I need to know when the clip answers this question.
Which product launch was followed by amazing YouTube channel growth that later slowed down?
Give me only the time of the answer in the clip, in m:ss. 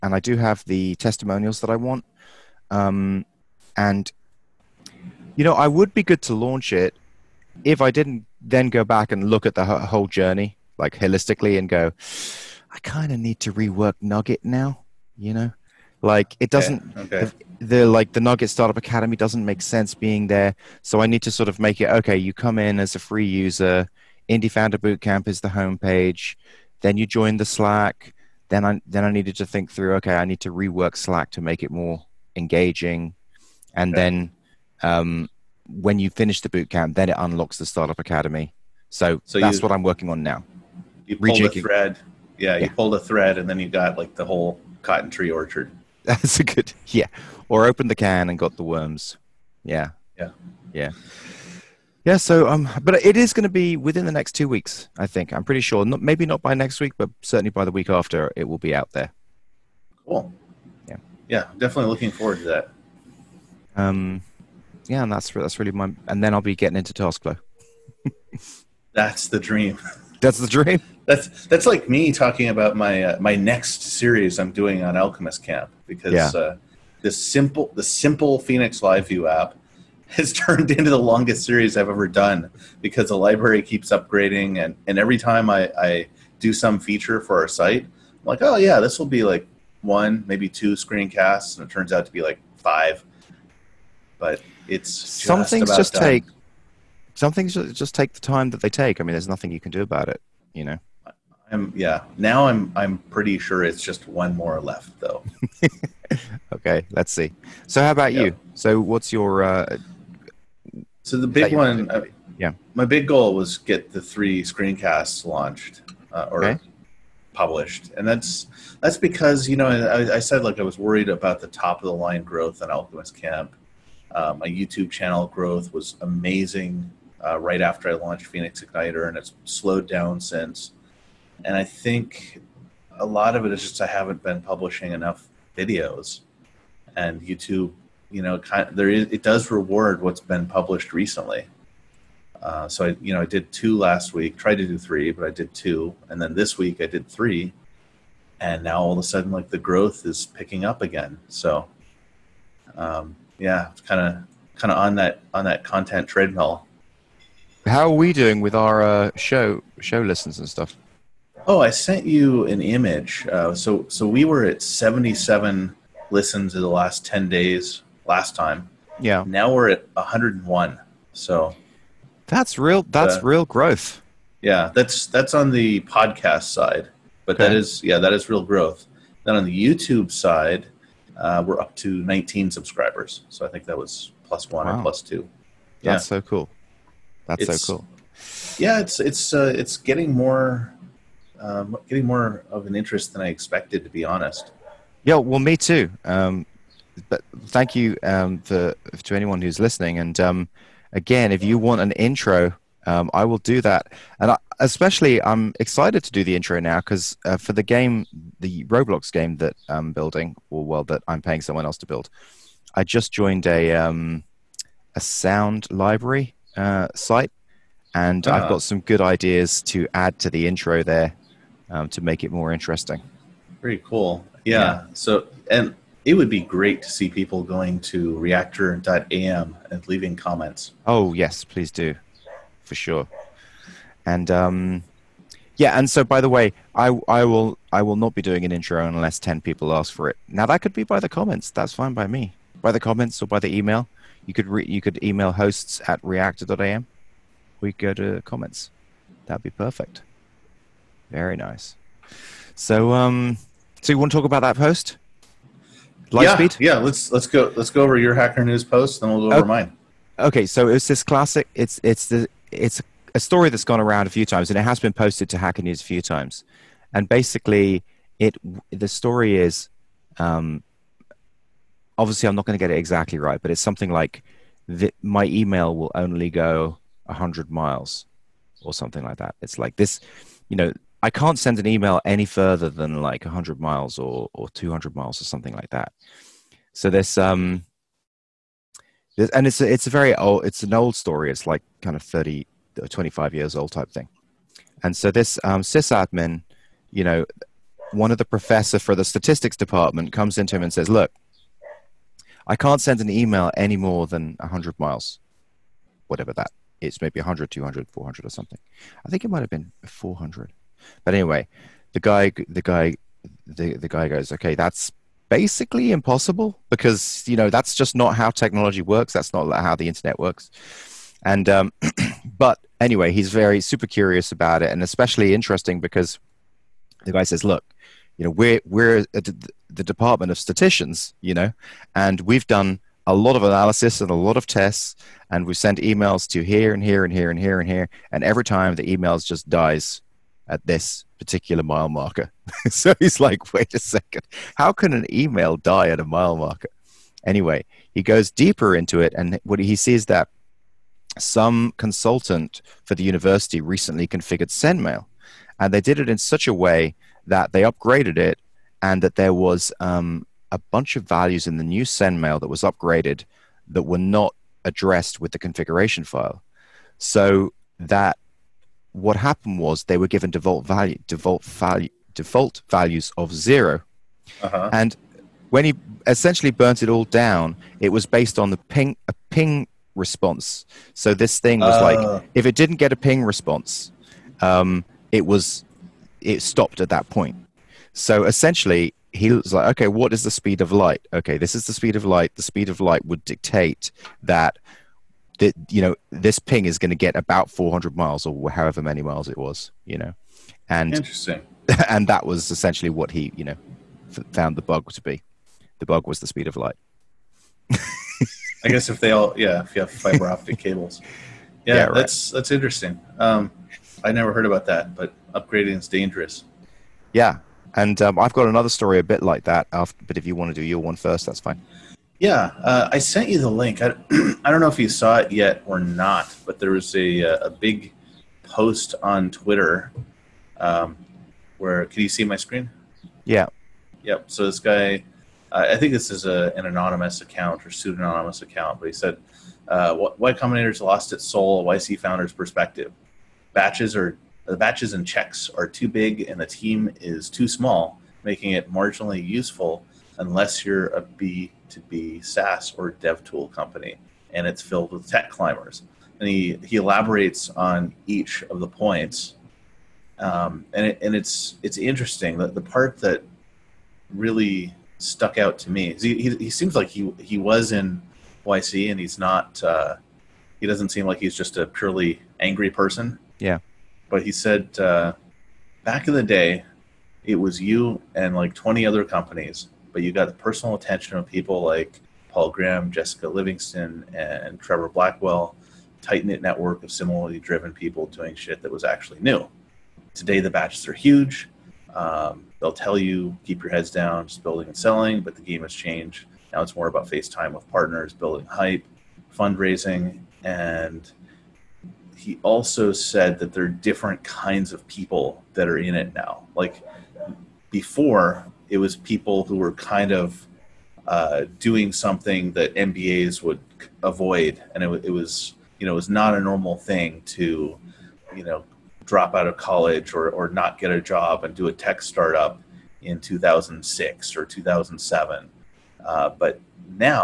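2:08.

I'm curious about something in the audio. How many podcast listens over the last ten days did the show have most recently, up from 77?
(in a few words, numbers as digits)
101.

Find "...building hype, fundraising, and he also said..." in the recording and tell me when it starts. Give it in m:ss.
8:18.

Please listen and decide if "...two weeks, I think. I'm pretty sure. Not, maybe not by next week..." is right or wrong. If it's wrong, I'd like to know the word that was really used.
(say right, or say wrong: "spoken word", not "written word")
right.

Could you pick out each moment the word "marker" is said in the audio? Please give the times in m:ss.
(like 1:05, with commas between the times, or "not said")
5:41, 5:46.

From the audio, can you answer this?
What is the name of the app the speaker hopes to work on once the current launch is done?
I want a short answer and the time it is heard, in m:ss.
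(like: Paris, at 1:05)
Taskflow, at 1:06.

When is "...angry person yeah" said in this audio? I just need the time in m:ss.
7:52.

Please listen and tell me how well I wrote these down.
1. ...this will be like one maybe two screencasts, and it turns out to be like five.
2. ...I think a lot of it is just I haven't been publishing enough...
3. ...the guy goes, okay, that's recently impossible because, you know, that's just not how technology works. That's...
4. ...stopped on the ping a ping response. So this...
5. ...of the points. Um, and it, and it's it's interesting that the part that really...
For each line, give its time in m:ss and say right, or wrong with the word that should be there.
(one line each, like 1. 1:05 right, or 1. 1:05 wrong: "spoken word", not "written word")
1. 1:28 right
2. 2:11 right
3. 5:13 wrong: "basically", not "recently"
4. 6:18 wrong: "based", not "stopped"
5. 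7:38 right.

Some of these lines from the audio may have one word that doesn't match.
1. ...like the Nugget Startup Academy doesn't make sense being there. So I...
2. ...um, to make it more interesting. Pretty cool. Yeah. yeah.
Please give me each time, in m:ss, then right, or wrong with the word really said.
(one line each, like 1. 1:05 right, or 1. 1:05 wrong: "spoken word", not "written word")
1. 0:17 right
2. 3:41 right.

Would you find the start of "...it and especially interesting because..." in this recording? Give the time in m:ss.
5:24.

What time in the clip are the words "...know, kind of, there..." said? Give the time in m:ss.
2:18.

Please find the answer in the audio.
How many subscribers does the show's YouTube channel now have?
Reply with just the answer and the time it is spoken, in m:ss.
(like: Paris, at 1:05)
19, at 3:01.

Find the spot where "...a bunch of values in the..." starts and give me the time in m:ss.
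6:00.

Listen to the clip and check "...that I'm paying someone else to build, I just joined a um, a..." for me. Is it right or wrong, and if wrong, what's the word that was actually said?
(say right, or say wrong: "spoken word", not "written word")
right.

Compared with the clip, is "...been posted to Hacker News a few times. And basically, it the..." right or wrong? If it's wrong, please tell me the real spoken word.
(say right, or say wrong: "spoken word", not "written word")
right.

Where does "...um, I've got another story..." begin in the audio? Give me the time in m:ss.
6:58.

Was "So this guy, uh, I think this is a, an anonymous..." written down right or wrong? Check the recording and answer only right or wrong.
right.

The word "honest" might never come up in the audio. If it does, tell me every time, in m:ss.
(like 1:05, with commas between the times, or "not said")
3:14.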